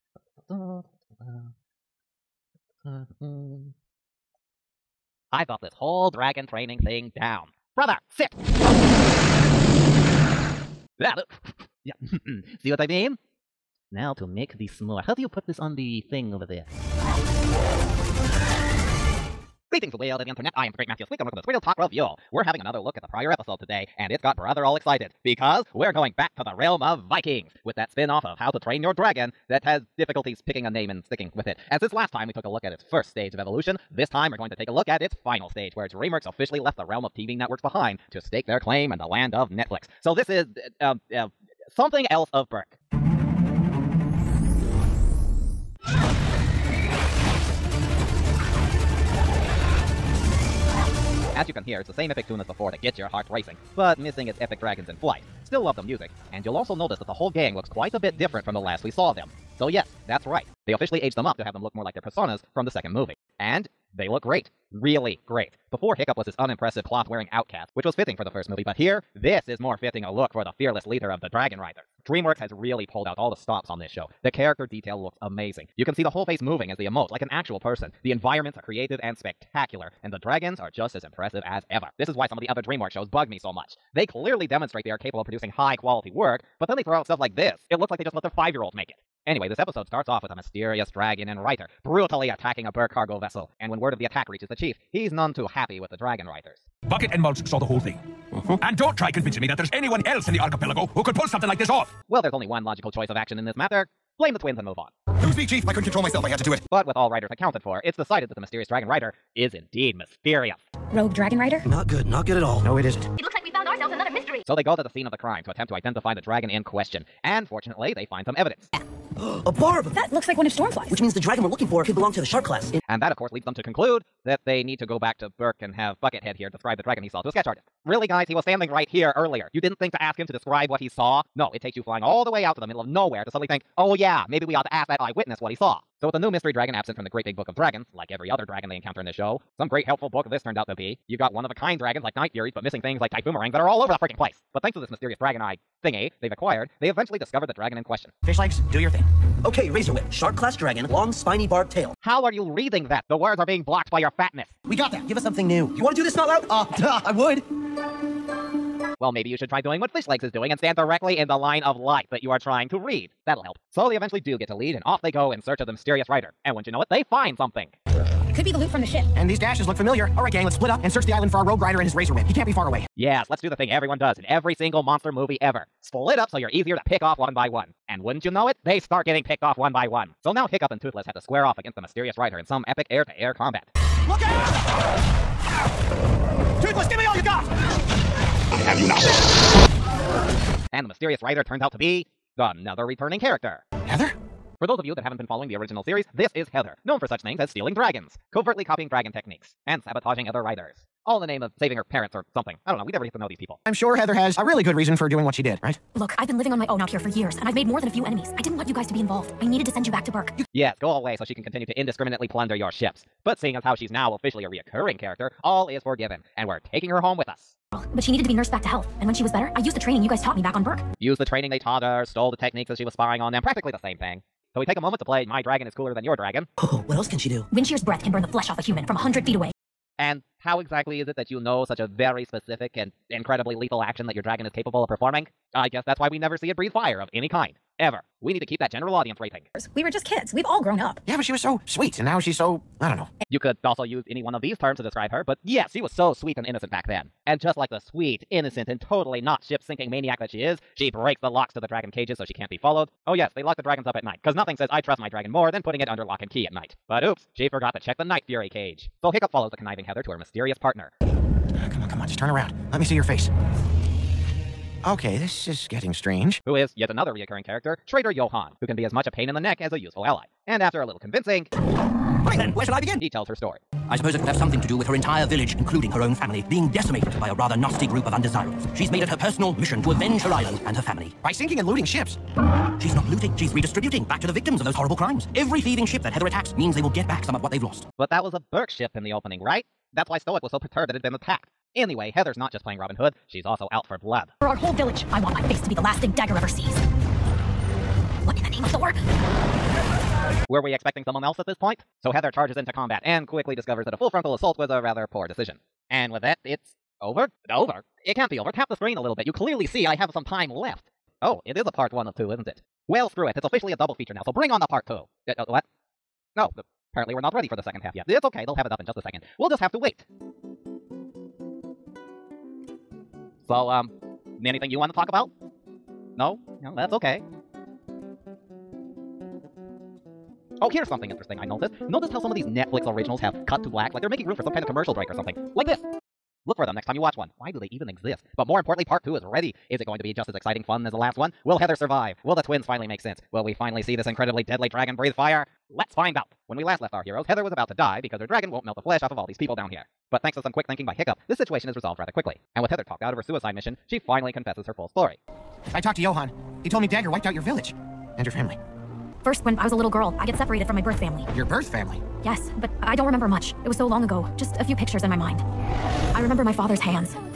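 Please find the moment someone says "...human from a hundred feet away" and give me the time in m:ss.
3:48.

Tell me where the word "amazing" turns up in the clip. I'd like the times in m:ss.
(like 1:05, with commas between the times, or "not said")
1:15.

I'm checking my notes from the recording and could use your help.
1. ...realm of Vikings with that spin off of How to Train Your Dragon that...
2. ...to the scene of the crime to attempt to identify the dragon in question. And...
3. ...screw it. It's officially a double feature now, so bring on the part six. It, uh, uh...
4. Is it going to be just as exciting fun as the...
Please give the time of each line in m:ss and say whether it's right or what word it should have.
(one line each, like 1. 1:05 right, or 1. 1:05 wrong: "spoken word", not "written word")
1. 0:26 right
2. 1:54 right
3. 5:13 wrong: "two", not "six"
4. 5:39 right.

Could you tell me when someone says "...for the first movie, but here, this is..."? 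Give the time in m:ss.
1:08.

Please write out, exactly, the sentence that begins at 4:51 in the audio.
Anyway, Heather's not just playing Robin Hood, she's also out for blood.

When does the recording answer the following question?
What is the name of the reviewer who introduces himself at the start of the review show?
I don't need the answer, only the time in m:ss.
0:20.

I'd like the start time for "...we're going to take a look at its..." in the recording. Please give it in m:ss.
0:34.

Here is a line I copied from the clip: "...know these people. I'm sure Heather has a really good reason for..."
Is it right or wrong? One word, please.
right.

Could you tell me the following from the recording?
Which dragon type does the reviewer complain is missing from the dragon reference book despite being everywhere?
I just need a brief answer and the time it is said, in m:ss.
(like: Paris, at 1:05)
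Typhoomerangs, at 2:23.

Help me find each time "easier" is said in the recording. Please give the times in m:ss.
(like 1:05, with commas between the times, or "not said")
2:56.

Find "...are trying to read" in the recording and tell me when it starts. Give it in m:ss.
2:42.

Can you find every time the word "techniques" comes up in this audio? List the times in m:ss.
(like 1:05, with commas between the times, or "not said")
3:19, 3:42.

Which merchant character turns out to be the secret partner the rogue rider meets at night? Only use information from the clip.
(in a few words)
Trader Johan.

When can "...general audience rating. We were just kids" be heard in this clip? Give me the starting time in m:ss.
3:58.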